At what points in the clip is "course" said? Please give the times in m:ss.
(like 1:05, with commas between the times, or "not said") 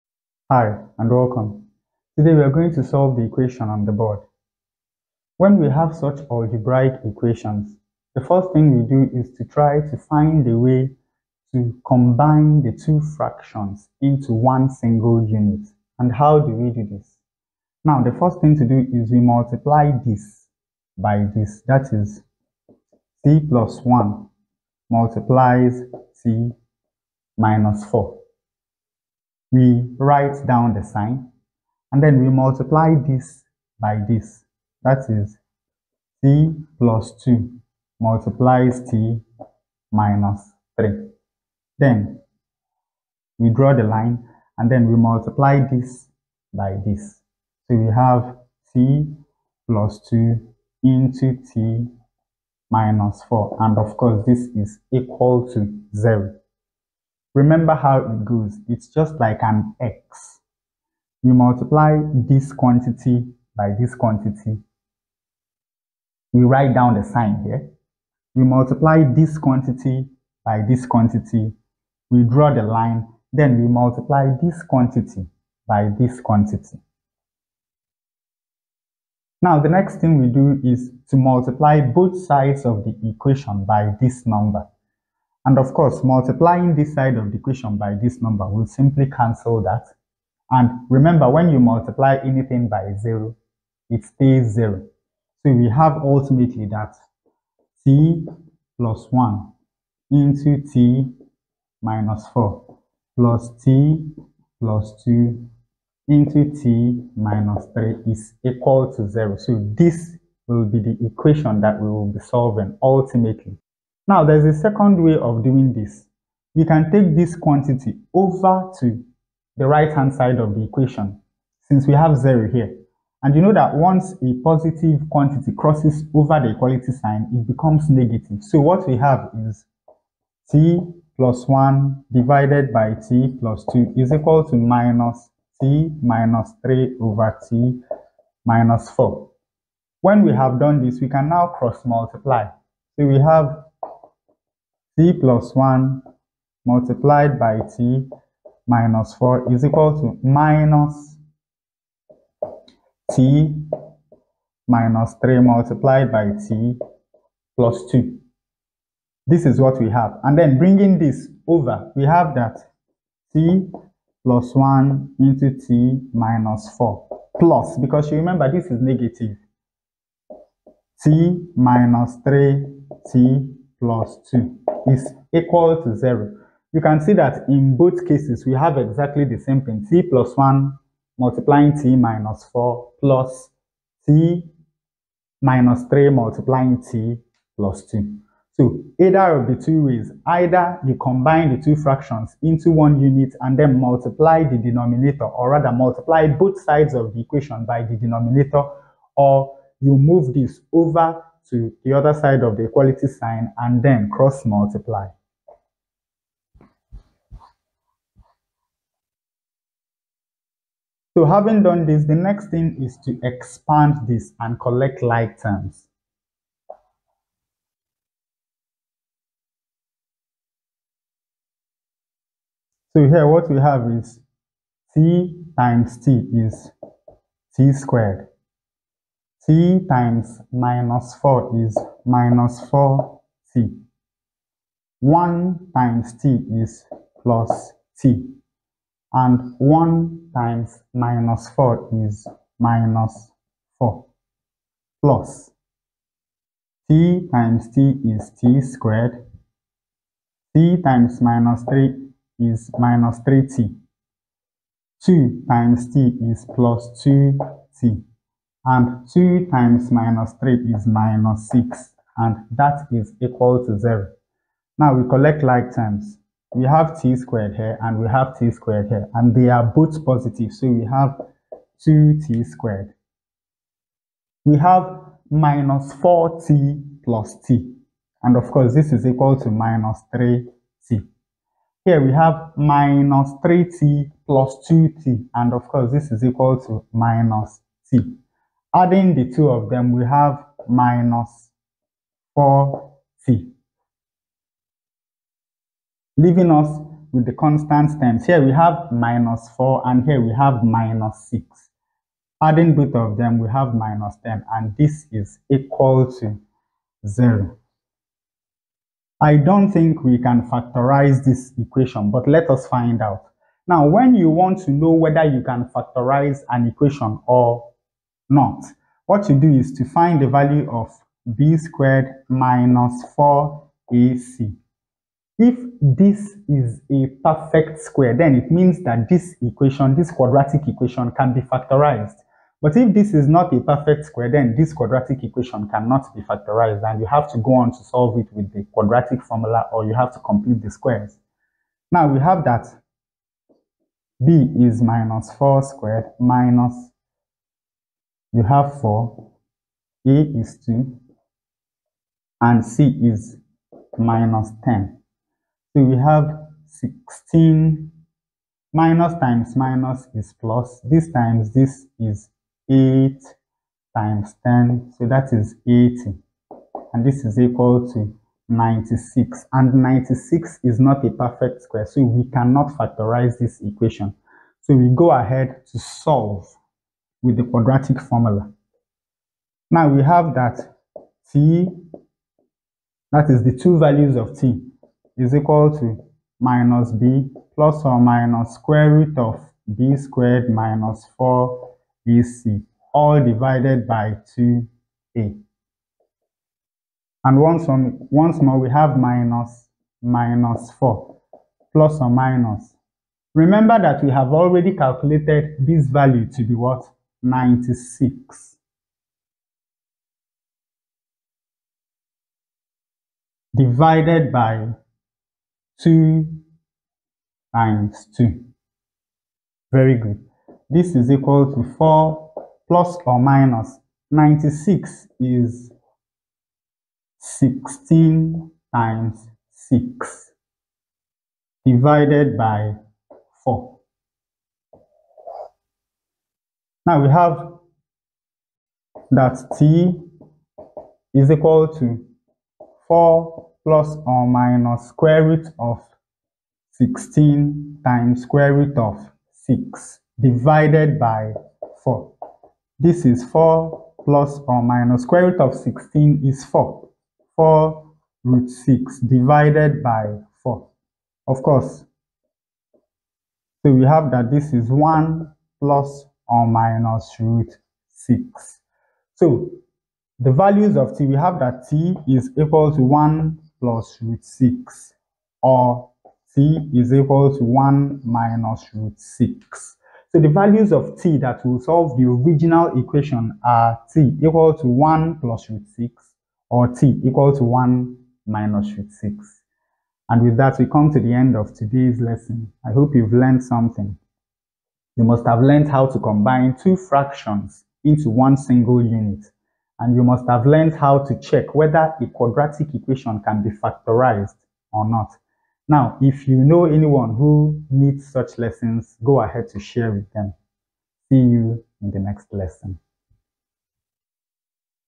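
0:53, 1:25, 4:38, 4:45, 7:41.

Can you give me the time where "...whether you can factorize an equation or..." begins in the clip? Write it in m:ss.
5:14.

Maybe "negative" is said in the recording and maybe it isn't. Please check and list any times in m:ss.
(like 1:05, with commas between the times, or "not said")
2:07, 2:48.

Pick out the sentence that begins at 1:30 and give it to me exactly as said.
And remember, when you multiply anything by zero, it stays zero.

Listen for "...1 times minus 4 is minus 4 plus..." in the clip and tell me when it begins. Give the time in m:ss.
3:59.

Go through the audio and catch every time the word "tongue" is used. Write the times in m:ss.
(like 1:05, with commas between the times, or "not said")
not said.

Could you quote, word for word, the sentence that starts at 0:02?
Today we are going to solve the equation on the board.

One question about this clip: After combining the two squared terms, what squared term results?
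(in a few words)
2t squared.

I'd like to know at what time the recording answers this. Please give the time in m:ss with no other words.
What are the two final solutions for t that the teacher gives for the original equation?
7:44.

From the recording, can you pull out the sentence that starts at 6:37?
And once, on, once more, we have minus minus 4 plus or minus.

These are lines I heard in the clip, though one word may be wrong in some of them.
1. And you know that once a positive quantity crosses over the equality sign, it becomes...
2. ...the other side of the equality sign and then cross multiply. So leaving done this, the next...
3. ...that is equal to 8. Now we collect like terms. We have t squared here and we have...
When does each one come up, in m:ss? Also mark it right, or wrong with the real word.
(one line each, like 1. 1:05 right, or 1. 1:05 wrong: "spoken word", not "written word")
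1. 2:03 right
2. 3:21 wrong: "having", not "leaving"
3. 4:22 wrong: "0", not "8".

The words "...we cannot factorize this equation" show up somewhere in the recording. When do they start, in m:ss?
6:12.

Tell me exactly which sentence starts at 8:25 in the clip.
Now, if you know anyone who needs such lessons, go ahead to share with them.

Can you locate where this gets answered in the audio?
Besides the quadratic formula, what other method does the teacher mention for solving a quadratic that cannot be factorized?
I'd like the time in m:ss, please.
5:40.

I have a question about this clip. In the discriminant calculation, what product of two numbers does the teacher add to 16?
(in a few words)
80.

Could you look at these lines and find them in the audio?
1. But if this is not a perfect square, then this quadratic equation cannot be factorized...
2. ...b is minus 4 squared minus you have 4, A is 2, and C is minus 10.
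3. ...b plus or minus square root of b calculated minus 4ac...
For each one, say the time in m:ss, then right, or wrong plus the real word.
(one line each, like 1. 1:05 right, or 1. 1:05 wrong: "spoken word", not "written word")
1. 5:32 right
2. 5:44 right
3. 6:26 wrong: "squared", not "calculated".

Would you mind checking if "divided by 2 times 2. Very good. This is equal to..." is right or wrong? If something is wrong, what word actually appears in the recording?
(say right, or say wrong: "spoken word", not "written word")
right.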